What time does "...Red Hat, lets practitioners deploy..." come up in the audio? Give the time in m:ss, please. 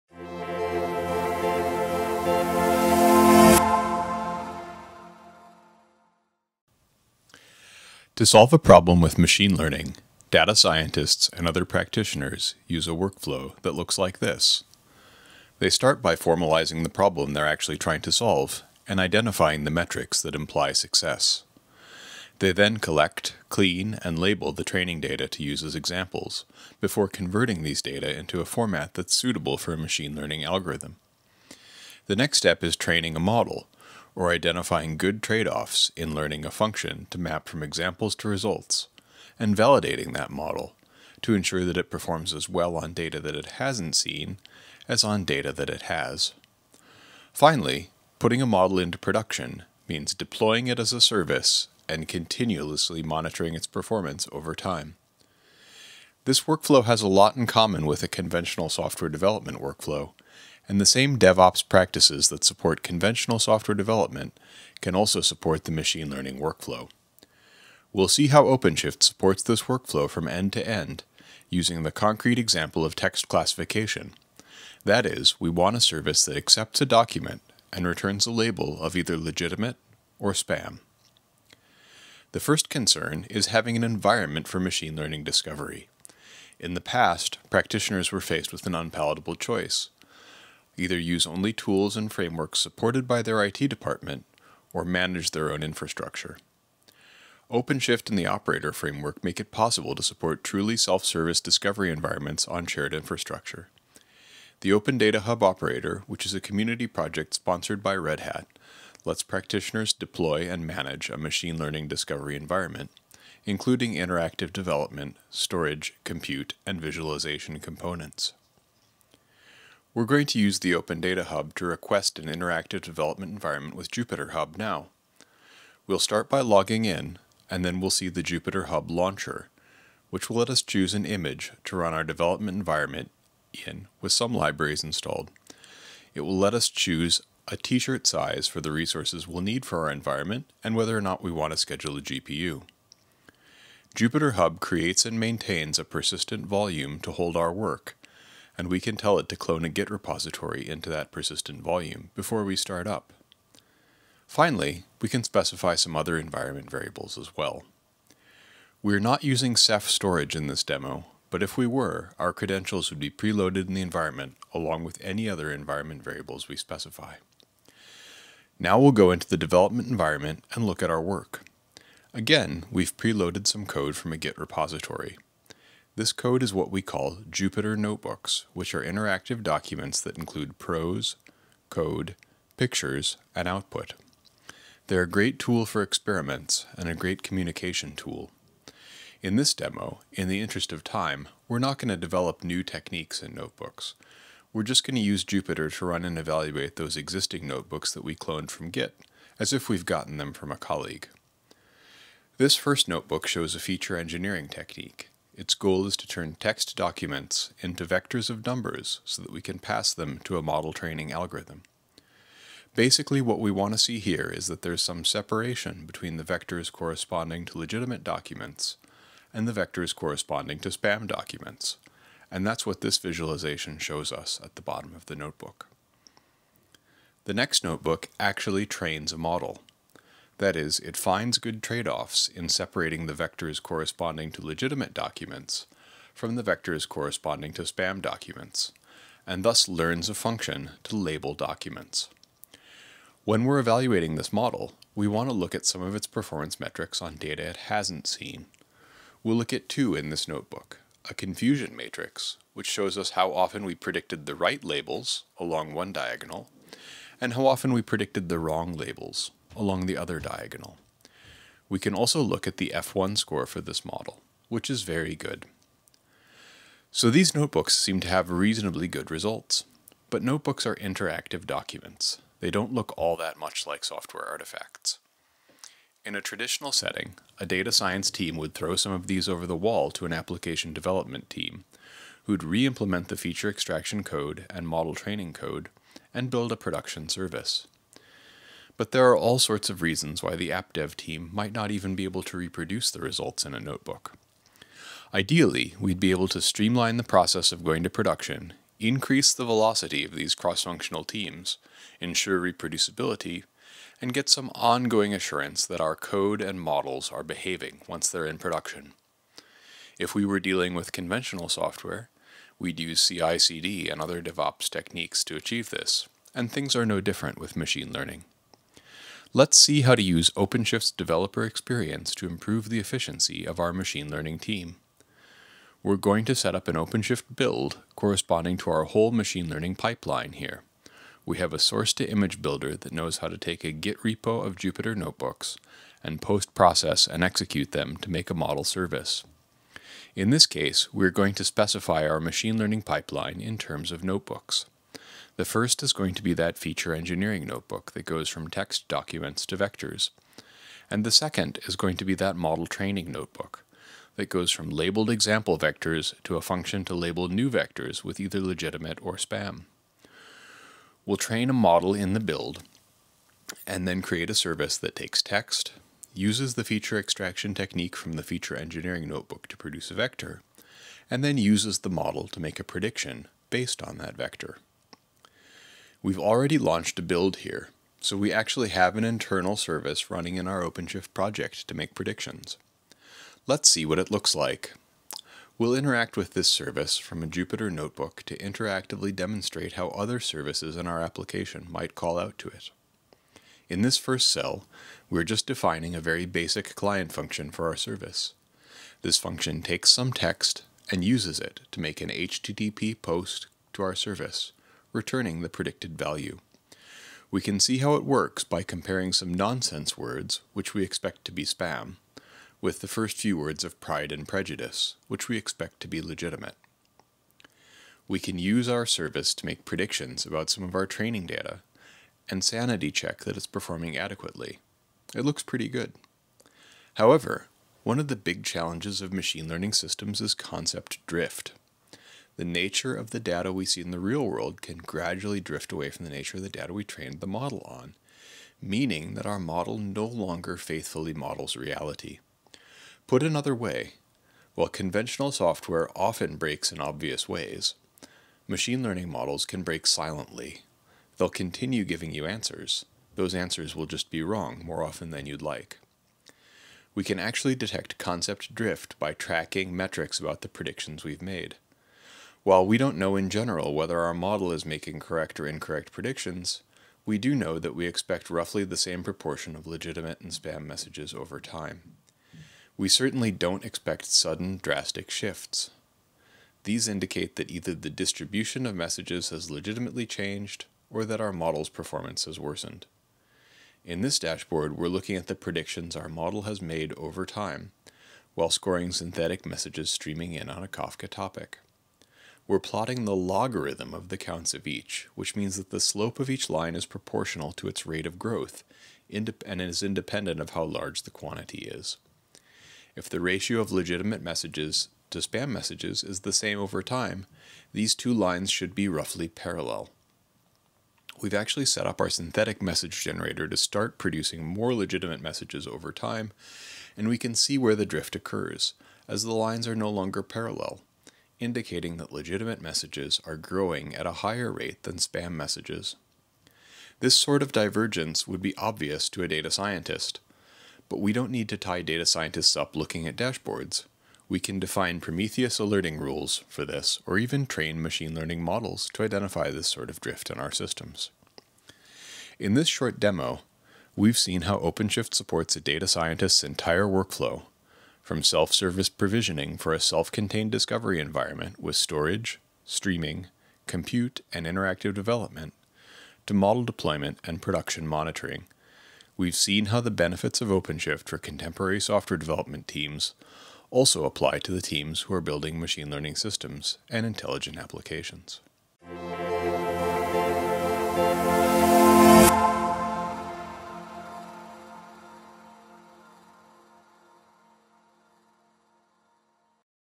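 1:47.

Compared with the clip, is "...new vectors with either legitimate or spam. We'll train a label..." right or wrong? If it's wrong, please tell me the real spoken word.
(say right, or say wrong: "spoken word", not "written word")
wrong: "model", not "label".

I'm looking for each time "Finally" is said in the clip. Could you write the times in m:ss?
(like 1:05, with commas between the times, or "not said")
0:47, 2:34.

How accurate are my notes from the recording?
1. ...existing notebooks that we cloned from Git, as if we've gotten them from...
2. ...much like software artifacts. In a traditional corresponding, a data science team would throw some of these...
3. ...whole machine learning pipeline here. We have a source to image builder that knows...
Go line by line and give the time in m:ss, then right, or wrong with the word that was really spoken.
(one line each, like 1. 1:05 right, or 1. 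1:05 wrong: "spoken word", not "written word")
1. 3:16 right
2. 4:33 wrong: "setting", not "corresponding"
3. 5:28 right.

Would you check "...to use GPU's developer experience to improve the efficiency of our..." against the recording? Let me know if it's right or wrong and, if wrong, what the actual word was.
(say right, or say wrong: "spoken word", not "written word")
wrong: "OpenShift", not "GPU".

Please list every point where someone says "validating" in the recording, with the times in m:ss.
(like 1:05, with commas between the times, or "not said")
0:39.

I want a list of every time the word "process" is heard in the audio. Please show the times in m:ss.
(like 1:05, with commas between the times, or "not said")
4:57, 5:36.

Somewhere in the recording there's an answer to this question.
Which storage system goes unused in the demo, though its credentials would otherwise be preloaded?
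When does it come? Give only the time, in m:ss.
2:39.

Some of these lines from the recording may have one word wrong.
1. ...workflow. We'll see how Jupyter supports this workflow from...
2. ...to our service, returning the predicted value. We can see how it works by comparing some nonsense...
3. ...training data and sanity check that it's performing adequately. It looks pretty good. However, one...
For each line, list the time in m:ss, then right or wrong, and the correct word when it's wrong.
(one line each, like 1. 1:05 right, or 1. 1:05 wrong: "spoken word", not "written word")
1. 1:06 wrong: "OpenShift", not "Jupyter"
2. 6:43 right
3. 7:00 right.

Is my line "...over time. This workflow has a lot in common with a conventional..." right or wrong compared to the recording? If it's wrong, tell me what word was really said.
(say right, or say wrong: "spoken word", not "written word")
right.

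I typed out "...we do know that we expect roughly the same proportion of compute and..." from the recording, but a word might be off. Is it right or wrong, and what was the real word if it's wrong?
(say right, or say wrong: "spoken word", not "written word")
wrong: "legitimate", not "compute".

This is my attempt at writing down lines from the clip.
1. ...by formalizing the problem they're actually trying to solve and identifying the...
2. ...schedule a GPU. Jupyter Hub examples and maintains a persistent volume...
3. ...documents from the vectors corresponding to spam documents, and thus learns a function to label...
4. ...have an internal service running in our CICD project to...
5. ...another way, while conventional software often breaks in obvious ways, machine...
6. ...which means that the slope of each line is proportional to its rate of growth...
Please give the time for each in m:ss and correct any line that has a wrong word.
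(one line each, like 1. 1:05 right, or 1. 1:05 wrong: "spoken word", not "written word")
1. 0:16 right
2. 2:21 wrong: "creates", not "examples"
3. 3:54 right
4. 6:18 wrong: "OpenShift", not "CICD"
5. 7:23 right
6. 8:15 right.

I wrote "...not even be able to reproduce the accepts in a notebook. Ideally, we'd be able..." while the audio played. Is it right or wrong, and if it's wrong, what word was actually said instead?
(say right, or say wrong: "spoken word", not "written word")
wrong: "results", not "accepts".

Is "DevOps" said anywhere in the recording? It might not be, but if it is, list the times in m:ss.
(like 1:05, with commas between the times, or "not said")
1:01, 5:14.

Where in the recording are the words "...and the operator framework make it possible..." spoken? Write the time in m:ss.
1:38.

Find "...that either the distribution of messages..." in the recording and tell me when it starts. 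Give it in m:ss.
7:57.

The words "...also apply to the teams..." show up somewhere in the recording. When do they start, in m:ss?
9:23.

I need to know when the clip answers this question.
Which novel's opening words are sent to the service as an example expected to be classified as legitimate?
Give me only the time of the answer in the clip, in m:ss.
6:53.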